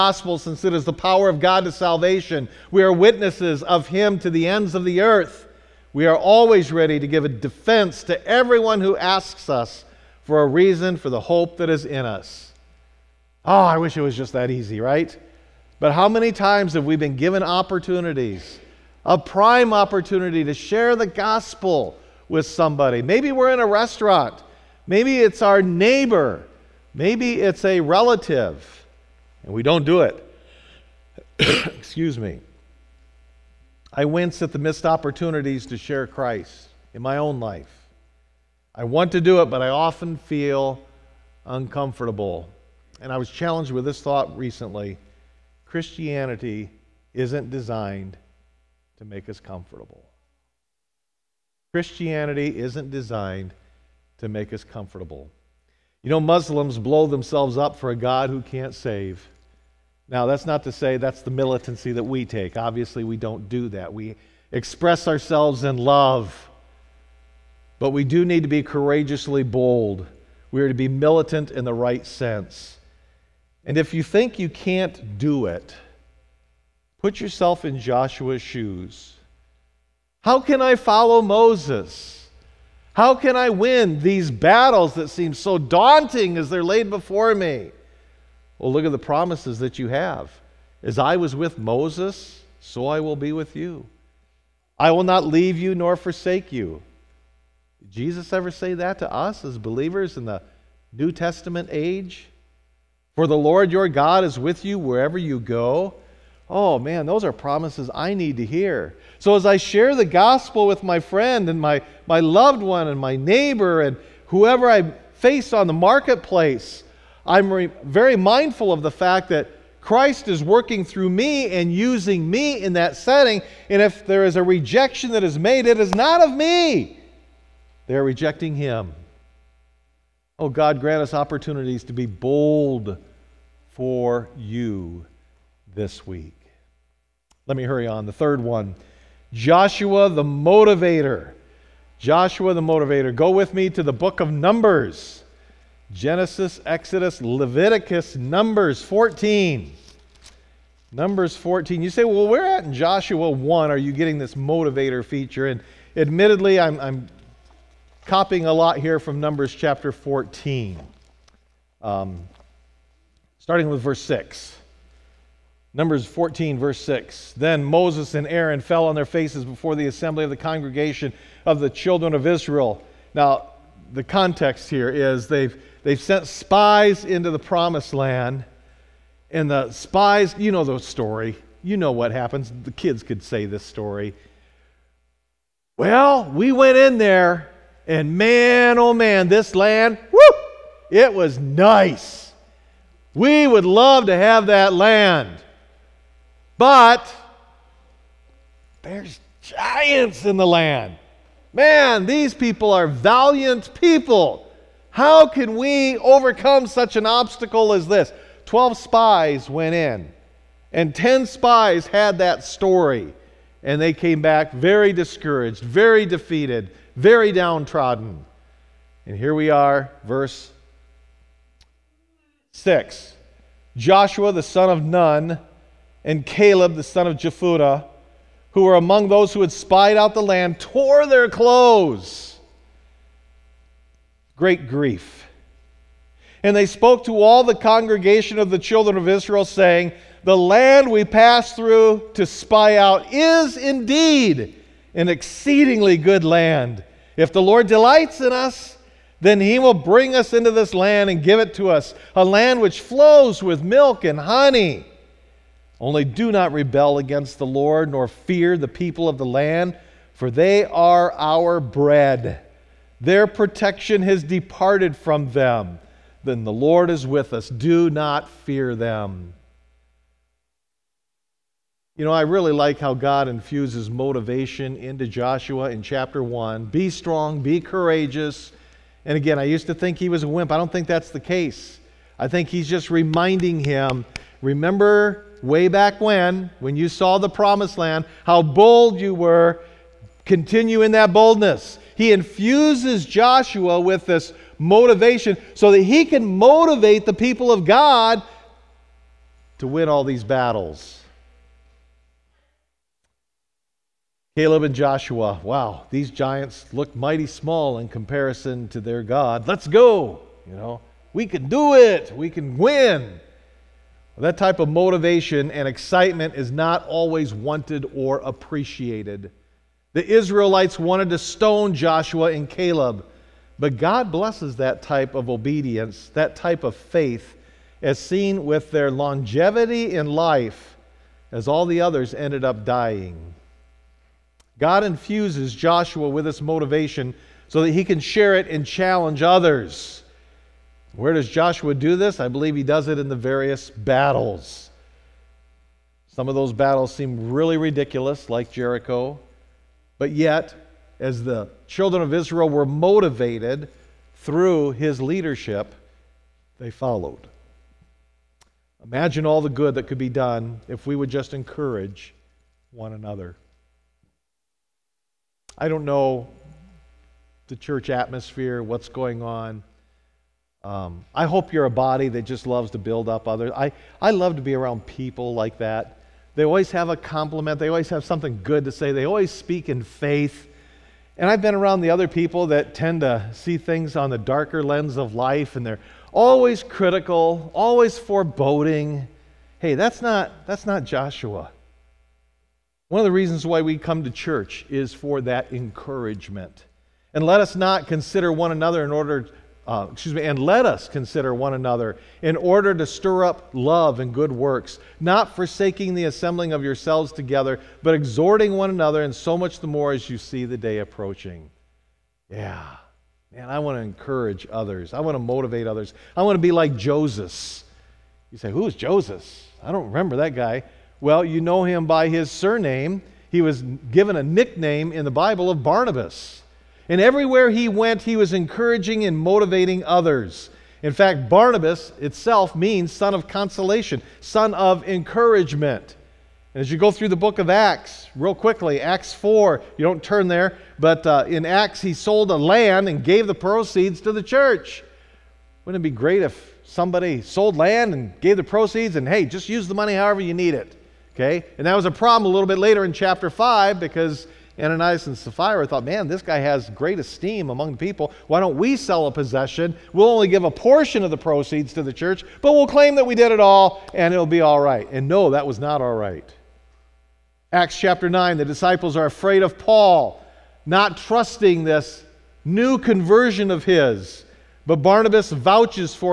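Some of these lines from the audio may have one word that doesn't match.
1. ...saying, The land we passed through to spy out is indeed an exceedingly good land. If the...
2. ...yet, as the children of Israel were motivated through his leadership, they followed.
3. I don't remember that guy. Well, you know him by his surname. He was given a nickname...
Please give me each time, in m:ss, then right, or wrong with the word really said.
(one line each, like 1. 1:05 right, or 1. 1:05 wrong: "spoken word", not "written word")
1. 3:59 right
2. 5:50 right
3. 6:59 right.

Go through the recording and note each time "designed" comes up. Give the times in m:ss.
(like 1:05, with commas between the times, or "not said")
0:47, 0:52.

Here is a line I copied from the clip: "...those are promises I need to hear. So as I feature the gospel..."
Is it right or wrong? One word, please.
wrong.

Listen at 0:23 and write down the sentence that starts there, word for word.
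Maybe we're in a restaurant, maybe it's our neighbor, maybe it's a relative, and we don't do it.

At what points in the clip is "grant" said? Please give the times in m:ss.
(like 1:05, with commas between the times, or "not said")
2:10.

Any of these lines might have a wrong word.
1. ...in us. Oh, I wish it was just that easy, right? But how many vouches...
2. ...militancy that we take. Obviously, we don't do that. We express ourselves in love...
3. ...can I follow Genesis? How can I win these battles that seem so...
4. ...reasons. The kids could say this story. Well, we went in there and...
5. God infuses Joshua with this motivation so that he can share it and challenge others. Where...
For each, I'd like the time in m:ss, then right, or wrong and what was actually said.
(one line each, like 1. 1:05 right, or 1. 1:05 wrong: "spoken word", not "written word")
1. 0:11 wrong: "times", not "vouches"
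2. 1:01 right
3. 1:20 wrong: "Moses", not "Genesis"
4. 3:02 wrong: "happens", not "reasons"
5. 5:34 right.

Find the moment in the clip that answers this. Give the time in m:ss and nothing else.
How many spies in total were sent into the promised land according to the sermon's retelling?
3:28.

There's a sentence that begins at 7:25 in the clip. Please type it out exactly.
Wouldn't it be great if somebody sold land and gave the proceeds and, hey, just use the money however you need it?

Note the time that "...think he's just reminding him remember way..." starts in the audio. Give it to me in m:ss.
4:42.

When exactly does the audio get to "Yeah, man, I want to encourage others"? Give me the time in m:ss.
6:52.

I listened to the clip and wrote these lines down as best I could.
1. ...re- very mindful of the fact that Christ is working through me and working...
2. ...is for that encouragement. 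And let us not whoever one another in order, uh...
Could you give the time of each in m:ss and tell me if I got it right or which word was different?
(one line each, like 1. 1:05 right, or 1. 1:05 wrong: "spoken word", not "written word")
1. 1:57 wrong: "using", not "working"
2. 6:34 wrong: "consider", not "whoever".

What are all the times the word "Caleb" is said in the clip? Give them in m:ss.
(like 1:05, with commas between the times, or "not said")
3:46, 5:04, 5:22.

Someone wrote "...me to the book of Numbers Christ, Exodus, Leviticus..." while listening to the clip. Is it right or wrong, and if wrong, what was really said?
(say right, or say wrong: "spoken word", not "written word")
wrong: "Genesis", not "Christ".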